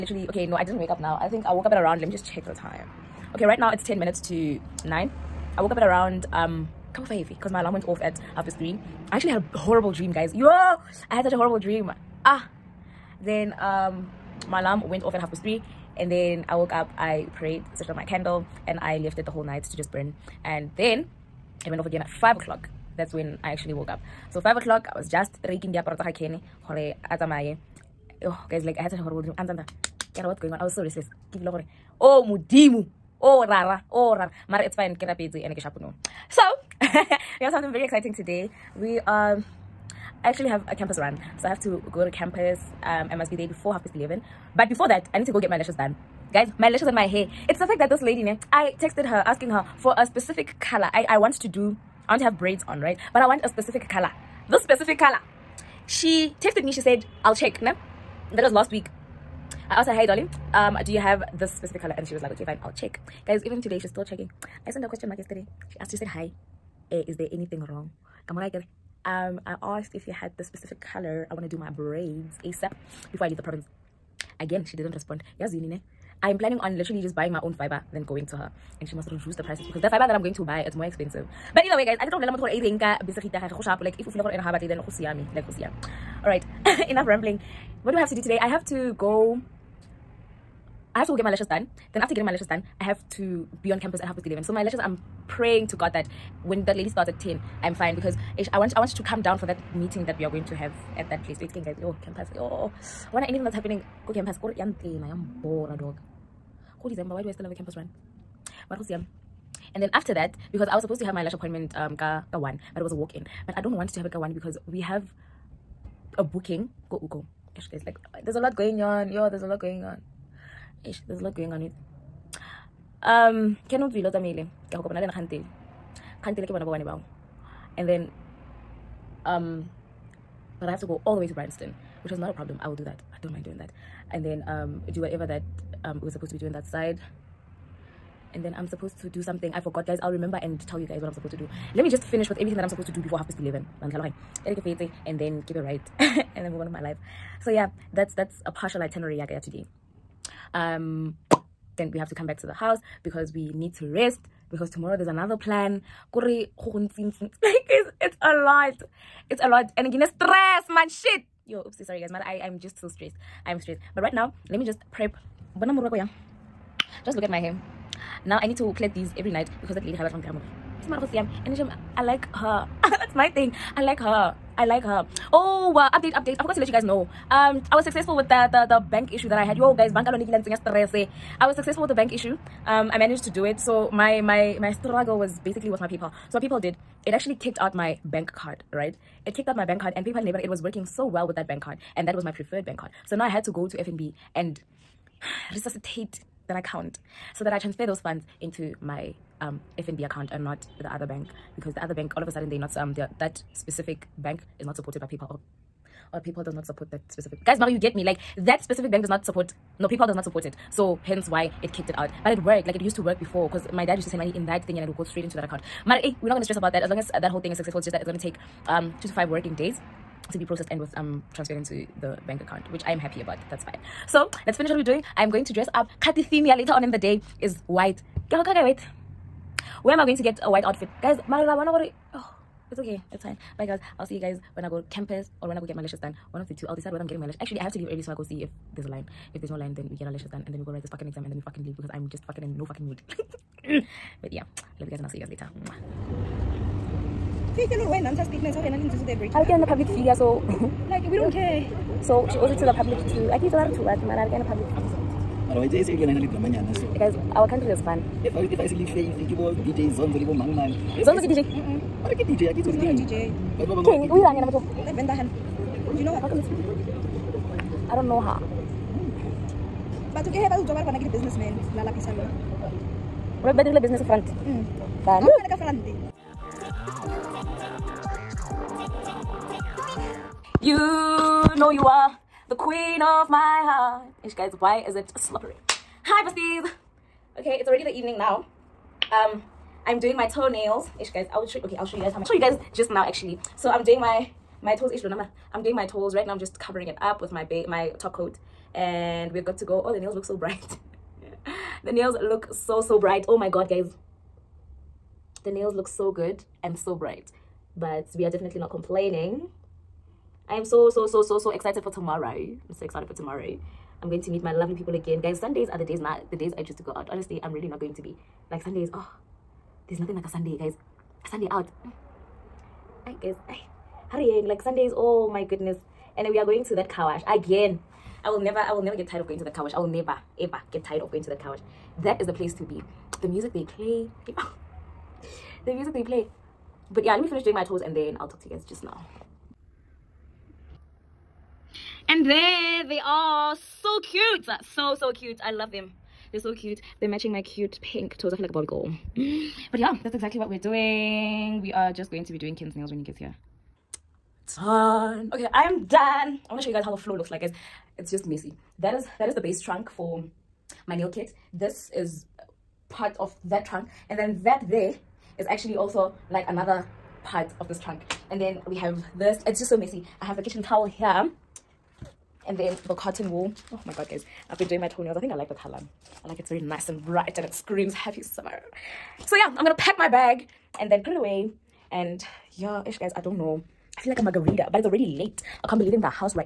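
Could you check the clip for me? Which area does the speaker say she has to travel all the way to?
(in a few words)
Bryanston.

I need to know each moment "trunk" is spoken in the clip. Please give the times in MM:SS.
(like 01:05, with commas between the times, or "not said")
05:59, 06:03, 06:07.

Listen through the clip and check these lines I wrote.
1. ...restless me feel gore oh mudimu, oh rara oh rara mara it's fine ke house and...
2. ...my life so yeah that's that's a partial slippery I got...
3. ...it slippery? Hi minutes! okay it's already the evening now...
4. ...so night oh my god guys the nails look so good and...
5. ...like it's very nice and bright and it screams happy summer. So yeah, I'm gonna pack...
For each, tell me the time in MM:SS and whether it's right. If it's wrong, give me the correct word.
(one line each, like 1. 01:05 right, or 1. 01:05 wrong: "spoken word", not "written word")
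1. 00:30 wrong: "rapetse", not "house"
2. 02:26 wrong: "itinerary", not "slippery"
3. 04:44 wrong: "besties", not "minutes"
4. 05:02 wrong: "bright", not "night"
5. 06:16 right.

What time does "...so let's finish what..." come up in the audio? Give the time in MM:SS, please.
03:44.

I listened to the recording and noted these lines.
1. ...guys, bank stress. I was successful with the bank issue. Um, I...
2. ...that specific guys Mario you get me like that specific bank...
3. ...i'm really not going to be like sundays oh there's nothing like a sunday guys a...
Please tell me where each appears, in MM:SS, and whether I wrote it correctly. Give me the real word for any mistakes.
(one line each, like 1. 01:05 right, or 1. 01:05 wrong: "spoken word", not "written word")
1. 02:59 right
2. 03:26 right
3. 05:17 right.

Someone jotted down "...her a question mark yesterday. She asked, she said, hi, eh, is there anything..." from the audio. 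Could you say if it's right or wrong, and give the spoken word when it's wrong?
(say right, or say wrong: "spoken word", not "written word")
right.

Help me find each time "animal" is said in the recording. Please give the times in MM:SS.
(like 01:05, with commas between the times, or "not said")
not said.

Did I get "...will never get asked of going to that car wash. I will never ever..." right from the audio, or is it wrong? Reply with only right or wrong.
wrong.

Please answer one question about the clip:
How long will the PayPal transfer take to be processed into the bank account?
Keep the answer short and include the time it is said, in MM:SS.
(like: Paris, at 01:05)
2 to 5 working days, at 03:39.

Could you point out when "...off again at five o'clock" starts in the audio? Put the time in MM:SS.
00:21.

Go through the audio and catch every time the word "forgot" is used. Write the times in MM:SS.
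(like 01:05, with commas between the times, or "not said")
02:19, 02:56.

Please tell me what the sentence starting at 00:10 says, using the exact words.
Yo, I had such a horrible dream.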